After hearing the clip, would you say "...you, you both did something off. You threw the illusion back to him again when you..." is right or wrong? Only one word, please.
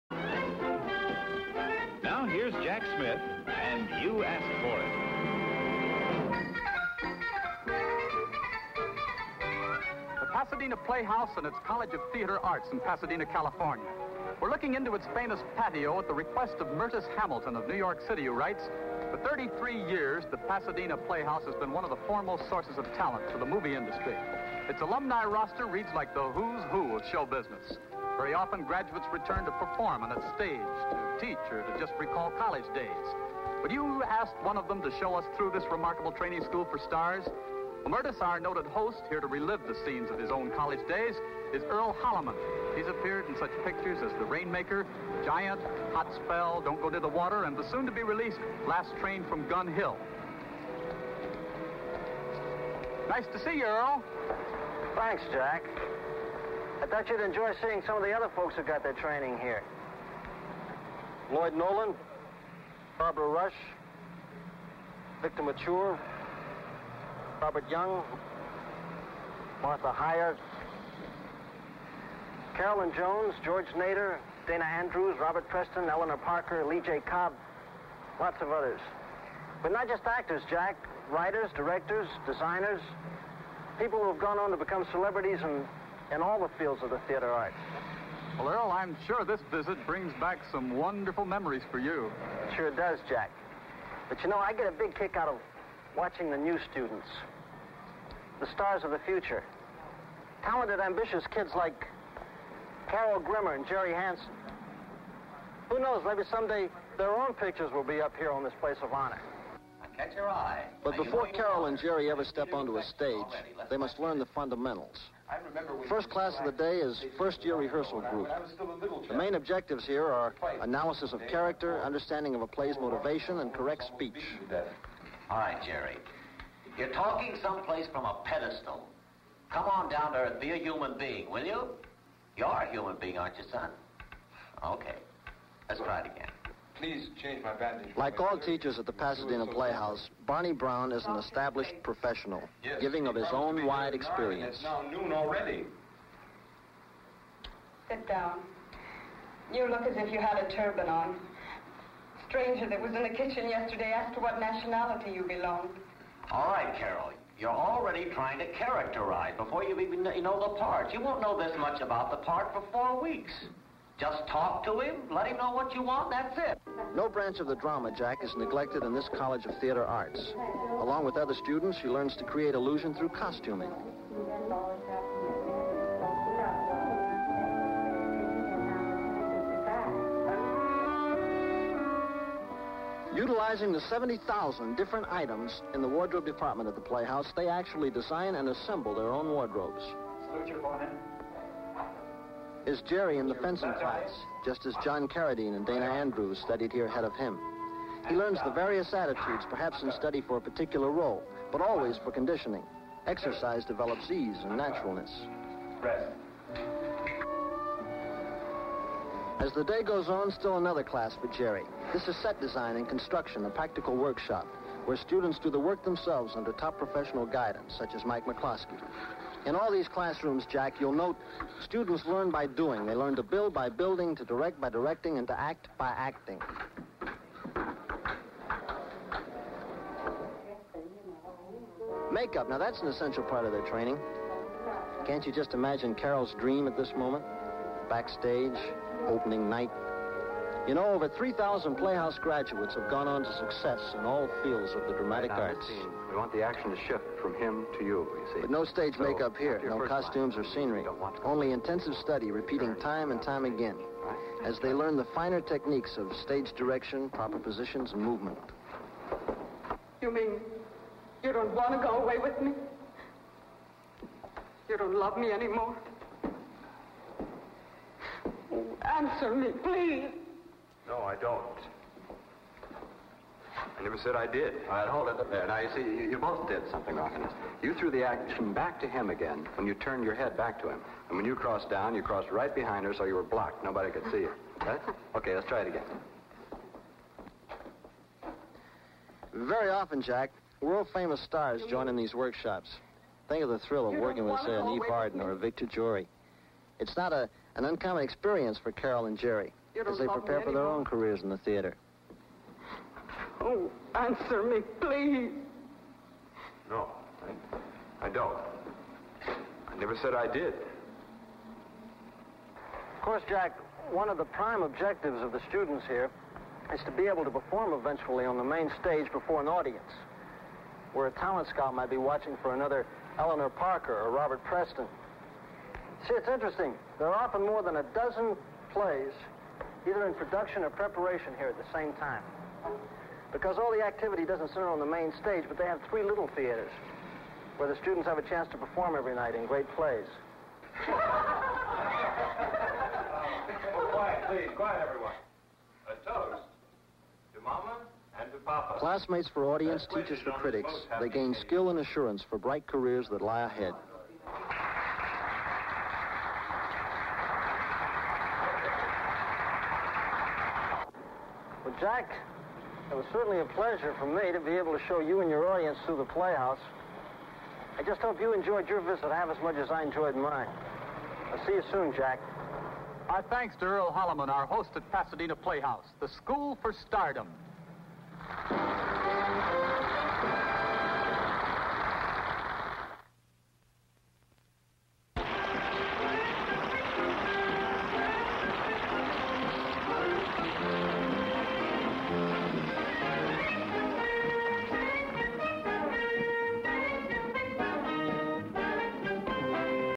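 wrong.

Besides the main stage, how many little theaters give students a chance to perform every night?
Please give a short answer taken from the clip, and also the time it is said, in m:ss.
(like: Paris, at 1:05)
3, at 5:35.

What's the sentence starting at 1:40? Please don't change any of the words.
Talented, ambitious kids like Carol Grimmer and Jerry Hansen.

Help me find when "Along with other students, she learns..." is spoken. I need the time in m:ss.
2:50.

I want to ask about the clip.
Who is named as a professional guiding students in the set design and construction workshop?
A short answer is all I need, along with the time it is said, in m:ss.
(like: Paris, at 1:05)
Mike McCloskey, at 3:38.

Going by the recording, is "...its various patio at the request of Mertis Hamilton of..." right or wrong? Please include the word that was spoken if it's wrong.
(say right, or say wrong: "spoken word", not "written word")
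wrong: "famous", not "various".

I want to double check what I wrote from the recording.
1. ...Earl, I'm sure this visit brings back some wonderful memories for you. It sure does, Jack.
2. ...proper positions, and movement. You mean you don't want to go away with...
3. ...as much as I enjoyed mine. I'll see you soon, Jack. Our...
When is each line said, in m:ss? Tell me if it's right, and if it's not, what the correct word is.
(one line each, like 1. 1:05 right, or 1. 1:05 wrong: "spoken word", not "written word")
1. 1:28 right
2. 4:17 right
3. 6:09 right.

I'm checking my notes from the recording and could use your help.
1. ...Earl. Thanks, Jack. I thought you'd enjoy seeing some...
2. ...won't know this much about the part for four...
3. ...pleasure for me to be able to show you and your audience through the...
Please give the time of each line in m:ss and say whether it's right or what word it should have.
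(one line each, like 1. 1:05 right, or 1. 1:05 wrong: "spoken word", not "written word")
1. 0:53 right
2. 2:41 right
3. 6:03 right.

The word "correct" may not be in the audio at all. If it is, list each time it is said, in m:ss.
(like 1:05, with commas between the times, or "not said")
2:03.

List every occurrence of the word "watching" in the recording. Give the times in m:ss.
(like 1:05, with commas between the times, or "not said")
1:35, 5:21.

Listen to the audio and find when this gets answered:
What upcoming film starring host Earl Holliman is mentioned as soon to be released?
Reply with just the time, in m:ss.
0:48.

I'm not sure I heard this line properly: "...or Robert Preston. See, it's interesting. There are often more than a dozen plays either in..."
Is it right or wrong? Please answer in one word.
right.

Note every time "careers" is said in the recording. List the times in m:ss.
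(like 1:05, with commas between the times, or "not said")
5:00, 5:52.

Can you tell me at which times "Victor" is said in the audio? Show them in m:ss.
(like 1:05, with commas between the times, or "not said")
1:05, 4:55.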